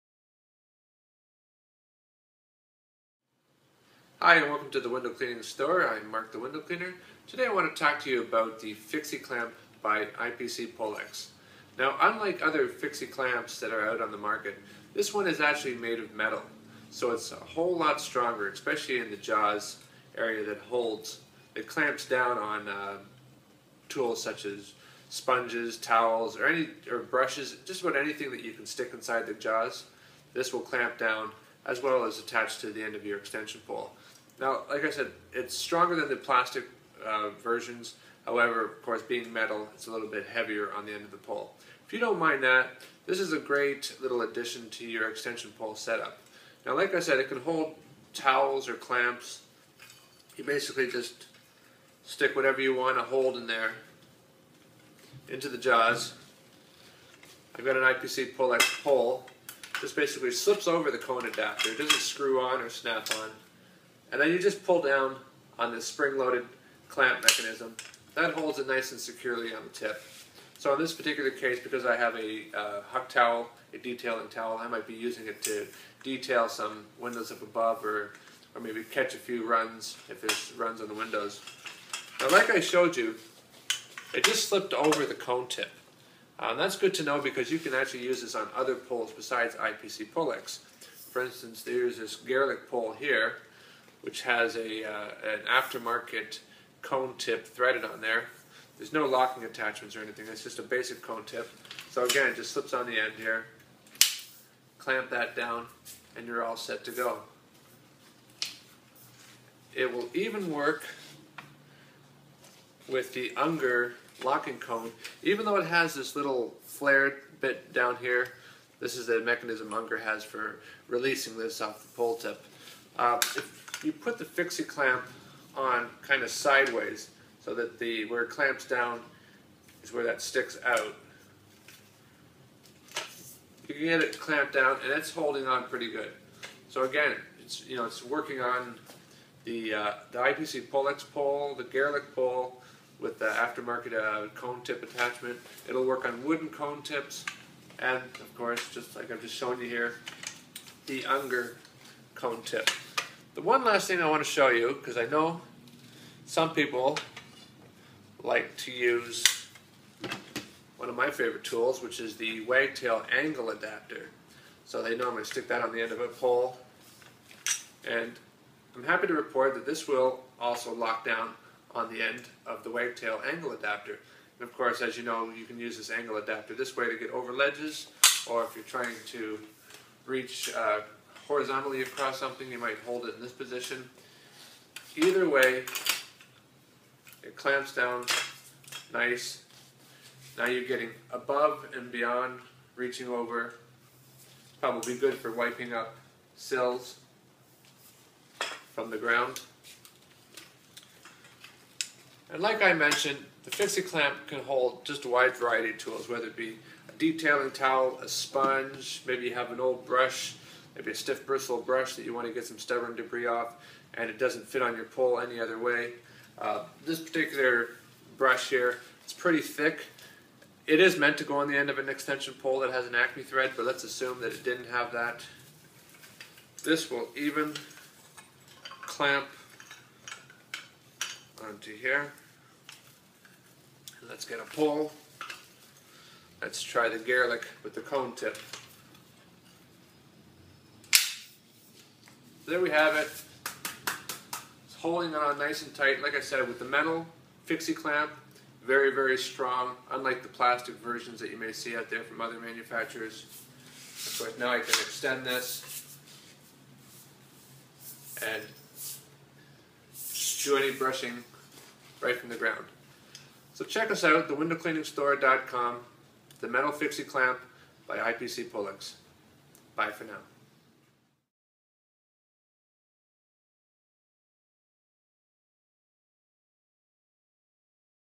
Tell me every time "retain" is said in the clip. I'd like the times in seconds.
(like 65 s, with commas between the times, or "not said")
not said.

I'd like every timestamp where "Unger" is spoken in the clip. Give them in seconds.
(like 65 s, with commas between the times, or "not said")
113 s, 119 s, 151 s.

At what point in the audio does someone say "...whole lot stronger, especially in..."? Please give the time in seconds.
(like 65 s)
17 s.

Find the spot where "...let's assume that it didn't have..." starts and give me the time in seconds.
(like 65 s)
223 s.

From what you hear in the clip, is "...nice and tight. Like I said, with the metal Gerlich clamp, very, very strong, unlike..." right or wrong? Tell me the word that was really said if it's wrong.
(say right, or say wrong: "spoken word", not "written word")
wrong: "Fixi", not "Gerlich".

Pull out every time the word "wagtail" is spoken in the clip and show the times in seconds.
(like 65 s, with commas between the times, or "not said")
162 s, 172 s.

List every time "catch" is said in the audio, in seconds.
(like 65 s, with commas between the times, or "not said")
78 s.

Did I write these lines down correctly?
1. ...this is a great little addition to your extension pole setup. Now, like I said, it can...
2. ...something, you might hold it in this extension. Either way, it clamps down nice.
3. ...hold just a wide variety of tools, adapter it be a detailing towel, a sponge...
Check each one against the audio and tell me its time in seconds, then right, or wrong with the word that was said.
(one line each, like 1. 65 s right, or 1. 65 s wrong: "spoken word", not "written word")
1. 43 s right
2. 182 s wrong: "position", not "extension"
3. 204 s wrong: "whether", not "adapter".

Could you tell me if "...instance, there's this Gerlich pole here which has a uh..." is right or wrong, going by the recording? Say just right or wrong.
right.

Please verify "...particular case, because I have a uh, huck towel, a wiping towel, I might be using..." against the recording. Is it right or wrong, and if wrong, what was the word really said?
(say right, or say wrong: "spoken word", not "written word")
wrong: "detailing", not "wiping".